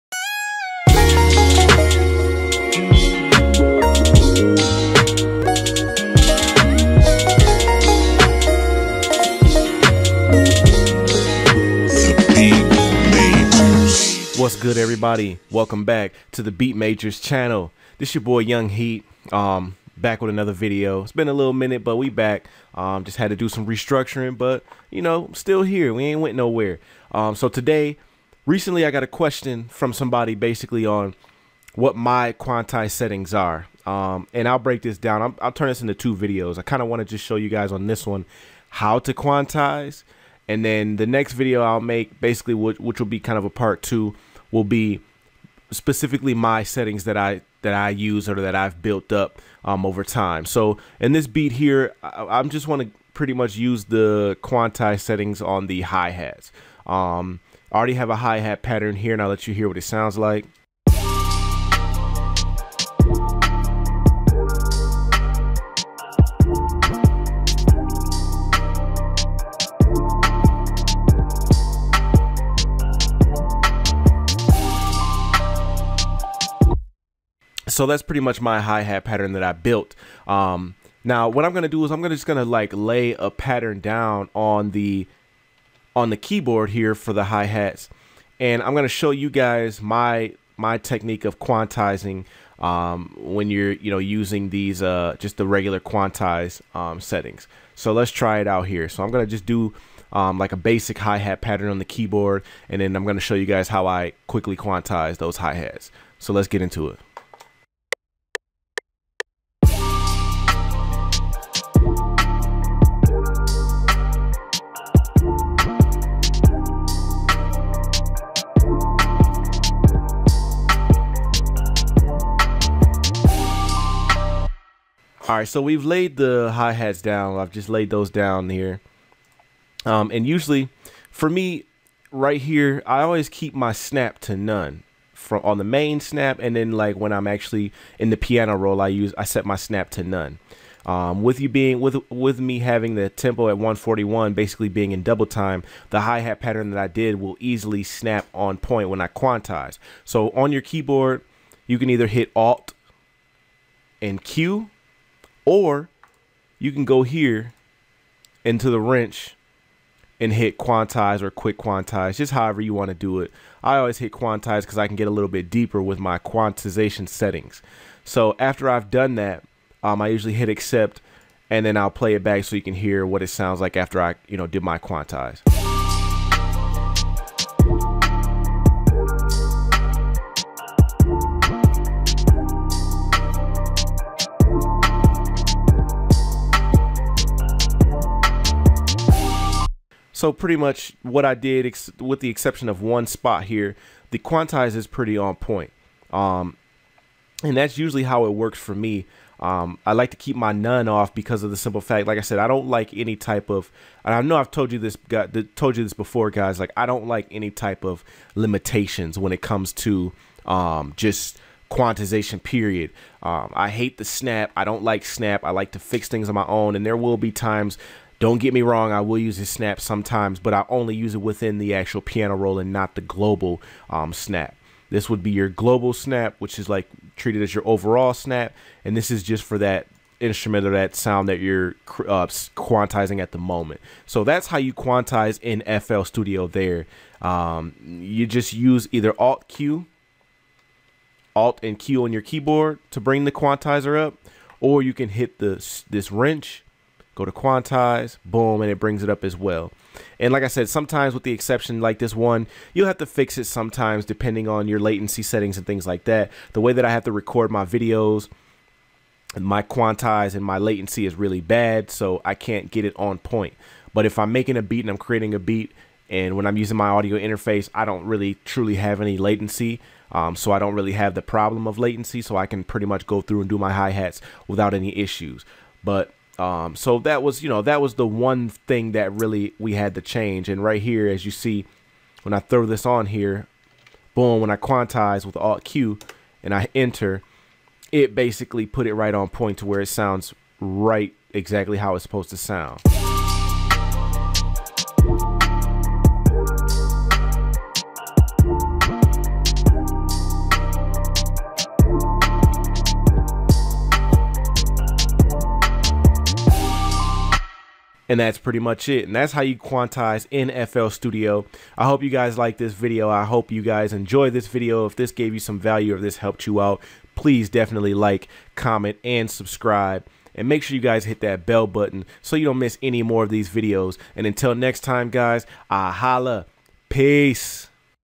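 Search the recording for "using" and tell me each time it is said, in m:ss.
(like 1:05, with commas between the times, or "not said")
1:33, 4:26.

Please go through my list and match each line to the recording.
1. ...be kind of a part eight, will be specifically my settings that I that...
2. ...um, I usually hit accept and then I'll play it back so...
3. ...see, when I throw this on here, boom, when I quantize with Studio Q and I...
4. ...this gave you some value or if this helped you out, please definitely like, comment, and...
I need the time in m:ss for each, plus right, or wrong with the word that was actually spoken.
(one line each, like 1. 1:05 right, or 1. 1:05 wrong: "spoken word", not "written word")
1. 0:43 wrong: "two", not "eight"
2. 2:49 right
3. 4:41 wrong: "Alt", not "Studio"
4. 5:14 right.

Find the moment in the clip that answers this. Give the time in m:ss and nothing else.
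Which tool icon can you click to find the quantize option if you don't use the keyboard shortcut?
2:38.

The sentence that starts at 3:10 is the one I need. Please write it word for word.
So pretty much what I did, with the exception of one spot here, the quantize is pretty on point.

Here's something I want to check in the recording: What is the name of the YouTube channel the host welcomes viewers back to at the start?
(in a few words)
Beat Majors.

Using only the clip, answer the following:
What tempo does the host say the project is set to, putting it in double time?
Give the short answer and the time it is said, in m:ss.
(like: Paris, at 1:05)
141, at 2:23.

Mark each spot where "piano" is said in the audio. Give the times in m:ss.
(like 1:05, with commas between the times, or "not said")
2:18, 3:42.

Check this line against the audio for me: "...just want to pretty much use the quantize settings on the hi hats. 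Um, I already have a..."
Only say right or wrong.
right.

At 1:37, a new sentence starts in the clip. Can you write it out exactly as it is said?
So let's try it out here.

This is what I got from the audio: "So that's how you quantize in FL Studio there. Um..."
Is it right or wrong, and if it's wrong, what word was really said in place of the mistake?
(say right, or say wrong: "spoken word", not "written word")
right.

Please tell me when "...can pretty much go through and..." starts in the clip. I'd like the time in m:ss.
4:32.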